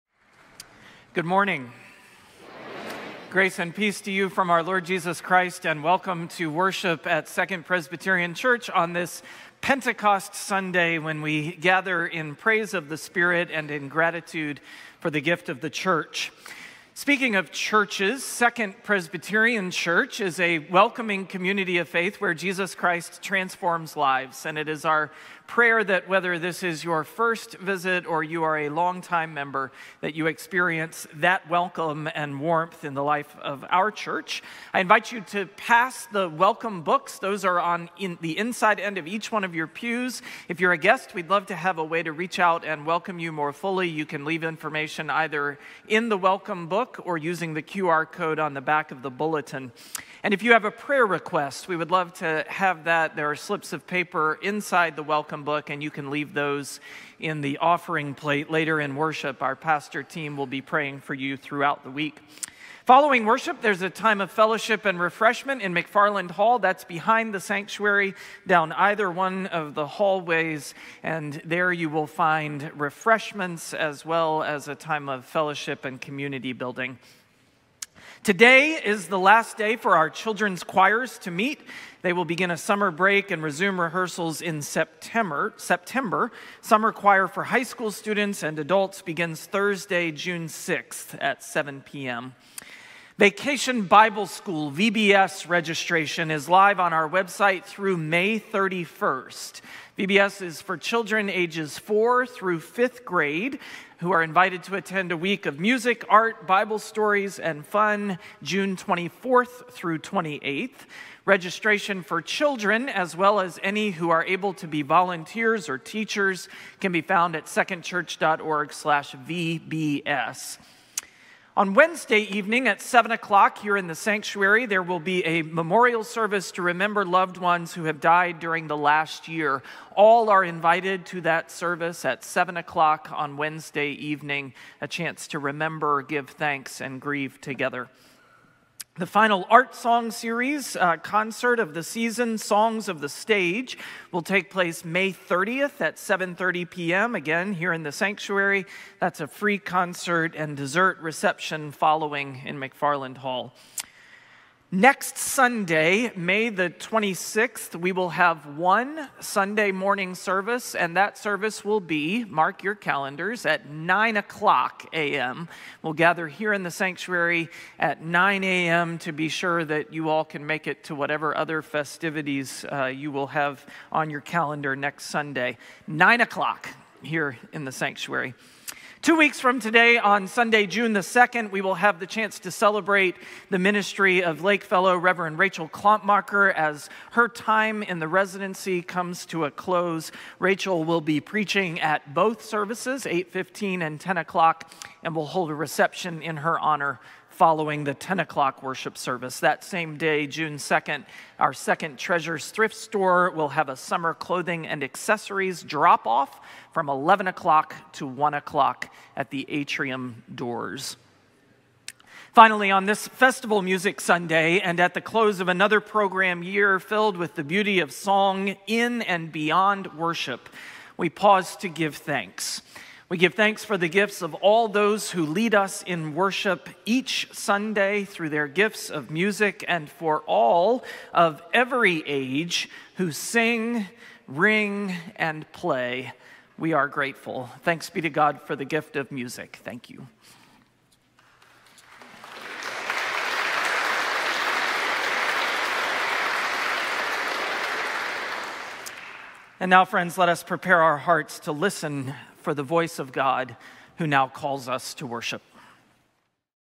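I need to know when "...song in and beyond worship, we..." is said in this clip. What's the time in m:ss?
3:37.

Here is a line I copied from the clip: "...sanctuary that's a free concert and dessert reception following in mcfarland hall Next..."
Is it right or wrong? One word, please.
right.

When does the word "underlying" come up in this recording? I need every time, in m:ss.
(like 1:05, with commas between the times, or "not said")
not said.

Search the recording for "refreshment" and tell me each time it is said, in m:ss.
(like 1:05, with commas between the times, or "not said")
1:04, 1:12.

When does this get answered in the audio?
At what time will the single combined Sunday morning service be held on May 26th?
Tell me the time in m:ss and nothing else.
2:43.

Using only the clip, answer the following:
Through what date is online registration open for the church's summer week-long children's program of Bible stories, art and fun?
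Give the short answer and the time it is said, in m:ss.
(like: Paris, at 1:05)
May 31st, at 1:37.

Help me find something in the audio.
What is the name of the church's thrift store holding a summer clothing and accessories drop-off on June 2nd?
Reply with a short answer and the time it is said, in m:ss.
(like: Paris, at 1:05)
Second Treasures, at 3:21.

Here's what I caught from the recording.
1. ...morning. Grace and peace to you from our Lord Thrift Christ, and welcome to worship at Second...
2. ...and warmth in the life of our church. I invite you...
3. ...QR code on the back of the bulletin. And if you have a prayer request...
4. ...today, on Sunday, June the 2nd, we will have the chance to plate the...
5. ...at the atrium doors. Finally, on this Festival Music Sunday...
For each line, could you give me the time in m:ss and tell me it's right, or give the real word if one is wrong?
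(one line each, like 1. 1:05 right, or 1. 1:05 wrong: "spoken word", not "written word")
1. 0:01 wrong: "Jesus", not "Thrift"
2. 0:32 right
3. 0:47 right
4. 2:59 wrong: "celebrate", not "plate"
5. 3:29 right.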